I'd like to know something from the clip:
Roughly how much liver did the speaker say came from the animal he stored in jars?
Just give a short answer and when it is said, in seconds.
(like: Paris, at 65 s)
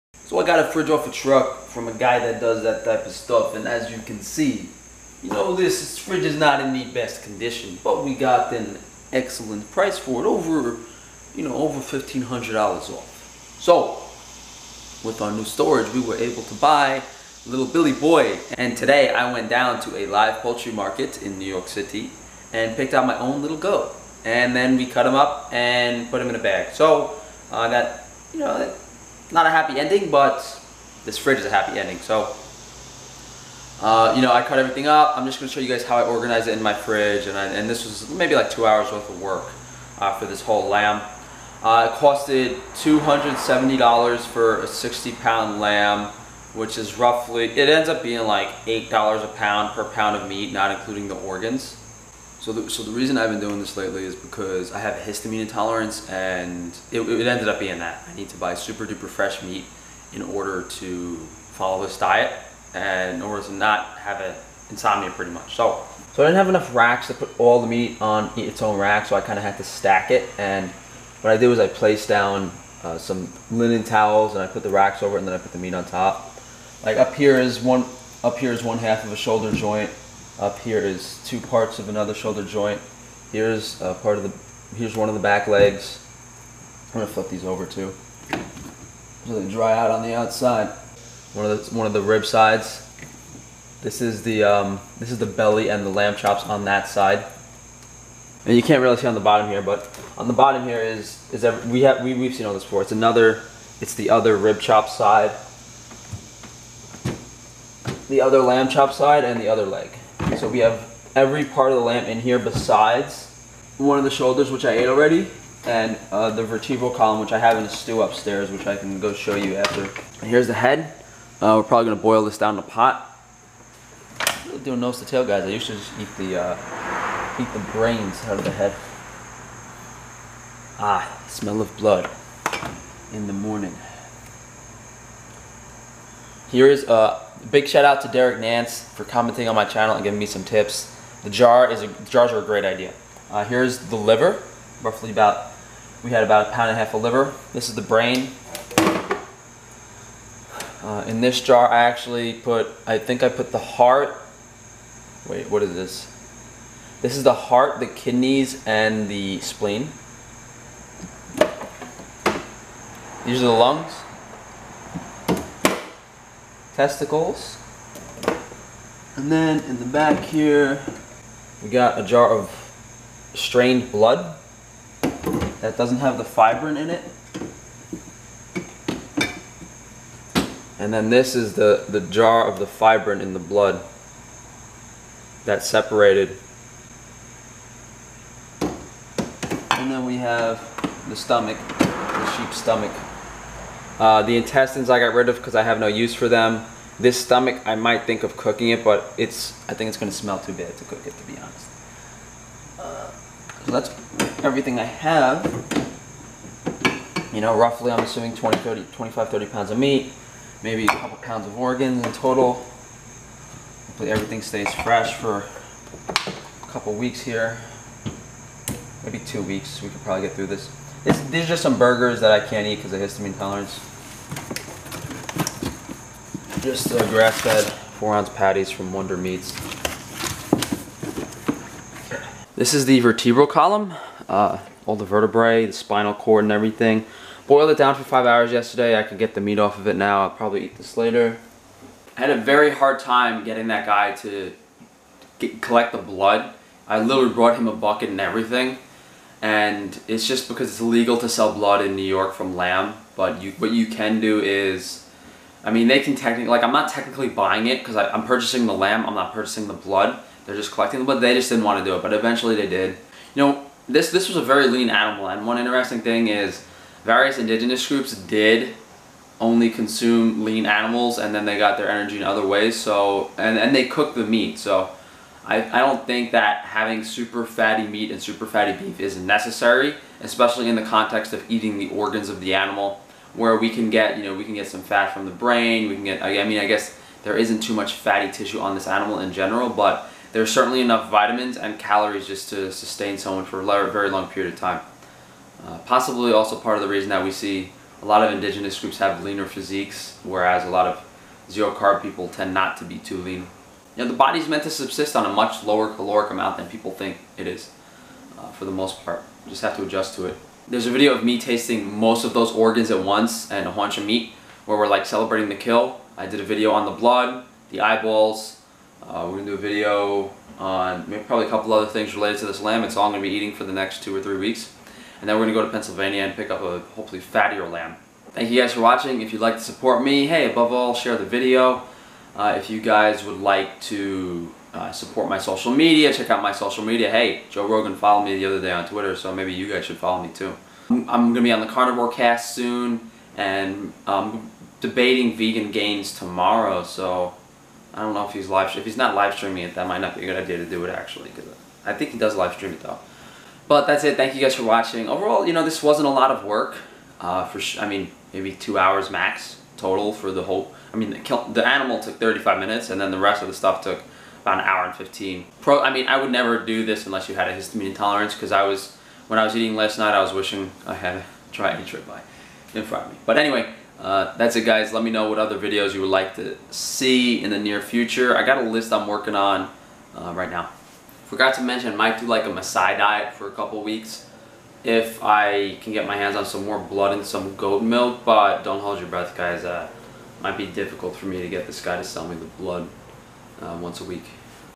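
a pound and a half, at 146 s.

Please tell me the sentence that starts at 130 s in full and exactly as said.
Ah, smell of blood in the morning.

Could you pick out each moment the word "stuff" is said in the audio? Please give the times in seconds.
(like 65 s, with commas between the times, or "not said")
3 s, 363 s.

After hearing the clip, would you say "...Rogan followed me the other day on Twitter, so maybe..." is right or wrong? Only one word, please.
right.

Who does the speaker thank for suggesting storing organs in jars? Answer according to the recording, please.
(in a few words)
Derek Nance.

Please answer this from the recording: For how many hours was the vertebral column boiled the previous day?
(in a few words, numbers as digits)
5.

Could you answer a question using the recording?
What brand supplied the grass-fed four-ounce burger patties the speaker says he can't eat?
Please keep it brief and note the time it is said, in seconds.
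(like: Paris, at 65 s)
Wonder Meats, at 228 s.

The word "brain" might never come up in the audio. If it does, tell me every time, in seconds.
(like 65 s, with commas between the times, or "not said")
127 s, 147 s, 285 s.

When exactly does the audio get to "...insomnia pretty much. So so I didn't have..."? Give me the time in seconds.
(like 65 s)
64 s.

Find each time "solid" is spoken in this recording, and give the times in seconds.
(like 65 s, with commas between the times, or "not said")
not said.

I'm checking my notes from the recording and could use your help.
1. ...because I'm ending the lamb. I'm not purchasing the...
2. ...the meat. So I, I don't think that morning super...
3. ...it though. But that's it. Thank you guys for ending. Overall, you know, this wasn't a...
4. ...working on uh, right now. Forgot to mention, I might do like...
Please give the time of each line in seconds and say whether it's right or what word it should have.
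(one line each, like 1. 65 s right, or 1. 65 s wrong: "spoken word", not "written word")
1. 257 s wrong: "purchasing", not "ending"
2. 274 s wrong: "having", not "morning"
3. 352 s wrong: "watching", not "ending"
4. 379 s right.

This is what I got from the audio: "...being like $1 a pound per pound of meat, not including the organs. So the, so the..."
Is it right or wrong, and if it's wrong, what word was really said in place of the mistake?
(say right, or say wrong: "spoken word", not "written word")
wrong: "8", not "1".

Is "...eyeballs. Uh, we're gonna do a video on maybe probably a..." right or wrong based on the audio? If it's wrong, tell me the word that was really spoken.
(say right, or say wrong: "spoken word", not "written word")
right.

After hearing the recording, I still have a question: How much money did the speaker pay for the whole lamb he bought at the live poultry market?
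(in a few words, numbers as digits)
$270.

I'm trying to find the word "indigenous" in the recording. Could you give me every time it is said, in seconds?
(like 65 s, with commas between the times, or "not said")
267 s, 298 s.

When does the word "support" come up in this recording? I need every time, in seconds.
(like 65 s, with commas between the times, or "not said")
329 s, 334 s.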